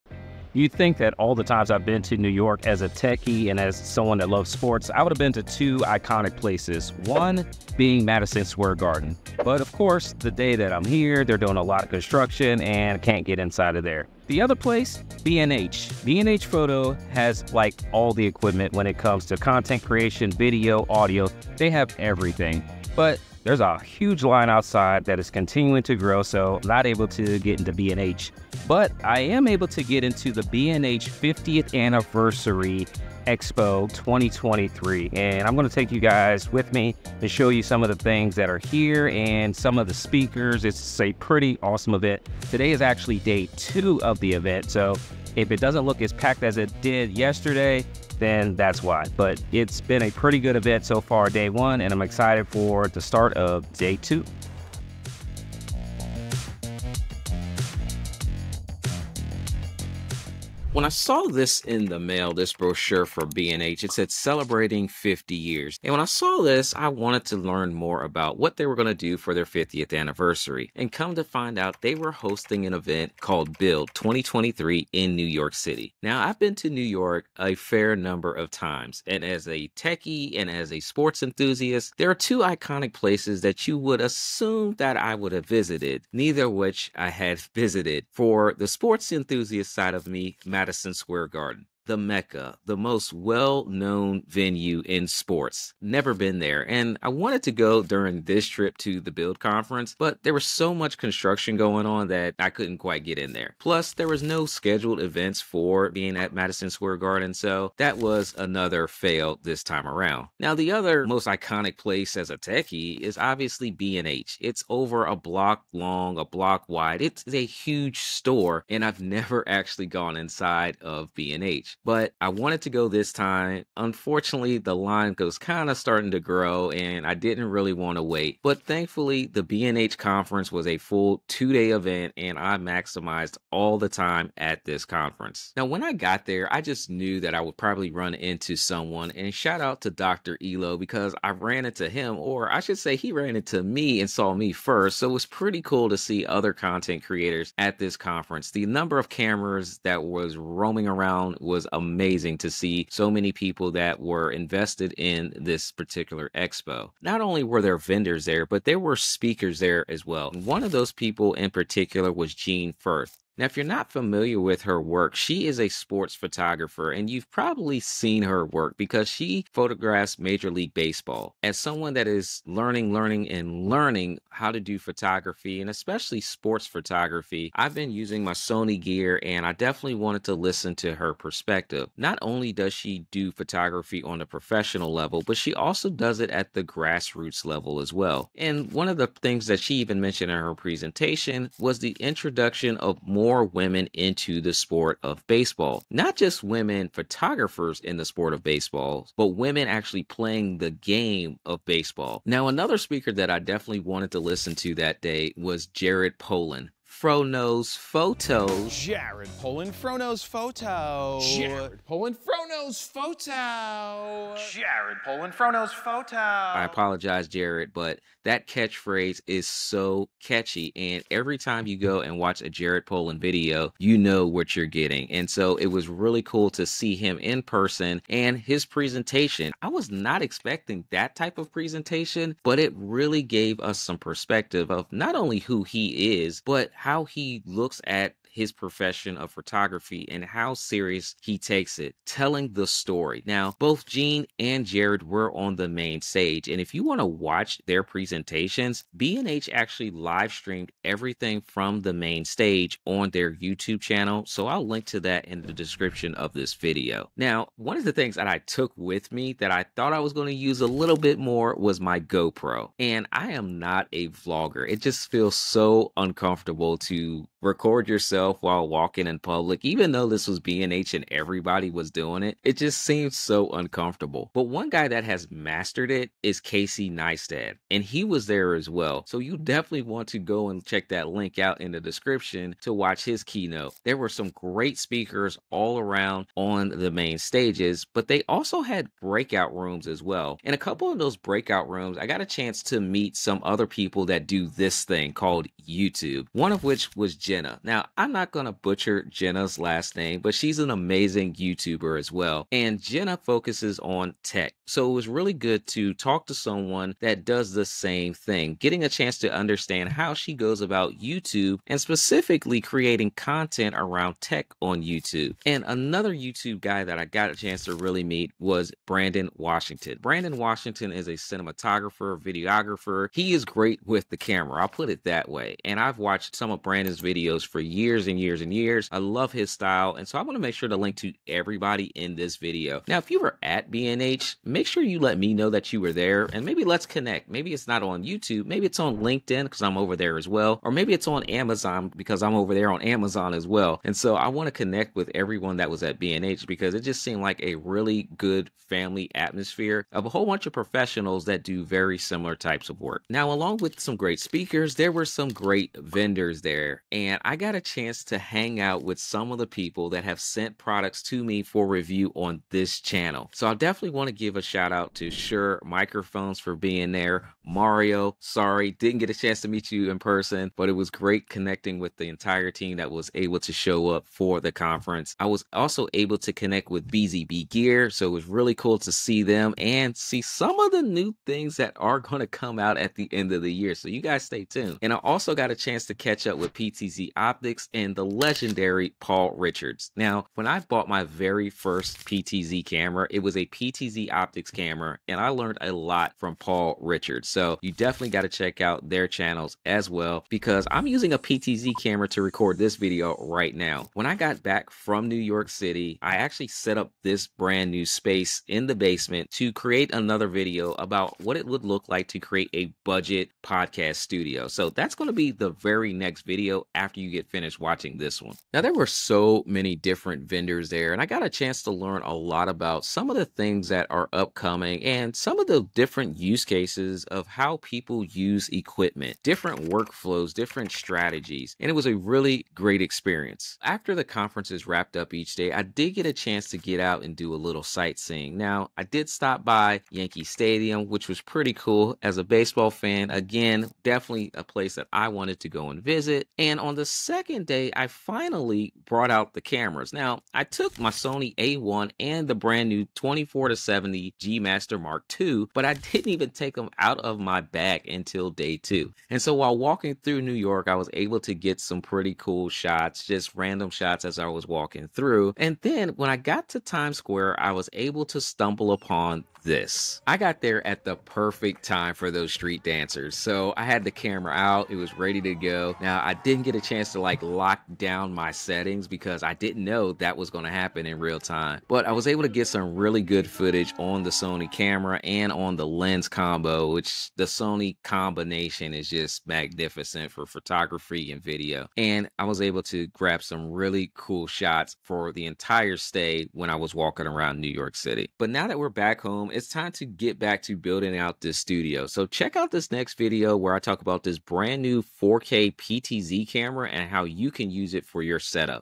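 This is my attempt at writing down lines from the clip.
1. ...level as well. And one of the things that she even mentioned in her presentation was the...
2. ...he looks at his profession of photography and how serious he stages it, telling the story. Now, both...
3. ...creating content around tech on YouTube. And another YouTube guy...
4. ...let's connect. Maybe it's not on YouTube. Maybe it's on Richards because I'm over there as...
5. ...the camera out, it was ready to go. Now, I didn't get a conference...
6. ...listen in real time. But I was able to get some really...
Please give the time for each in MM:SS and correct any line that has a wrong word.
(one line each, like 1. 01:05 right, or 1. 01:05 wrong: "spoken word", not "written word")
1. 03:07 right
2. 03:57 wrong: "takes", not "stages"
3. 05:12 right
4. 05:36 wrong: "LinkedIn", not "Richards"
5. 07:53 wrong: "chance", not "conference"
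6. 08:00 wrong: "happen", not "listen".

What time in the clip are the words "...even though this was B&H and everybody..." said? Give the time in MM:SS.
04:29.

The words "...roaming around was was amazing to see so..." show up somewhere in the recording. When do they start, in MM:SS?
02:30.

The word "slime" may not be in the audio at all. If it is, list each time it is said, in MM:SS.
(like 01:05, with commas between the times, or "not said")
not said.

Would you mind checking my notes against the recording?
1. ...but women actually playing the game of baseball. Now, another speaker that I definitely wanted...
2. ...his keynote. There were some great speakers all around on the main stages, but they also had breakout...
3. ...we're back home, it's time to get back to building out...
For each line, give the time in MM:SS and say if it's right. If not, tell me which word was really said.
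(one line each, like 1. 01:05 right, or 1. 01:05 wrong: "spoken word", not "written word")
1. 03:19 right
2. 04:43 right
3. 08:18 right.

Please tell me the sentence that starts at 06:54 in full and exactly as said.
So that's going to be the very next video after you get finished watching watching this one.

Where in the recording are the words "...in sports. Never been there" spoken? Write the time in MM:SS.
01:34.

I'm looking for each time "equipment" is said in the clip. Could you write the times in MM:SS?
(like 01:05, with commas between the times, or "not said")
00:18, 07:08.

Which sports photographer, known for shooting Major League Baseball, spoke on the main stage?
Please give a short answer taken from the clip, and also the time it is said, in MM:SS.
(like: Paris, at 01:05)
Jean Fruth, at 02:42.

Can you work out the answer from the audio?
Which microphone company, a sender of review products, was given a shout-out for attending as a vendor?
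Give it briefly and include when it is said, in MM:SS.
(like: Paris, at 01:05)
Shure, at 06:05.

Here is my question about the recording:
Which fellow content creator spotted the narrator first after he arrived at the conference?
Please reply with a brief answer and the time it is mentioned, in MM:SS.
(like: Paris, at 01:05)
Dr. Elo, at 02:19.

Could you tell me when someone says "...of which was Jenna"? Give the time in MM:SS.
04:56.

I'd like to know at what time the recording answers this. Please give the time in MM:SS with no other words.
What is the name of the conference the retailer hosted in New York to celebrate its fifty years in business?
01:13.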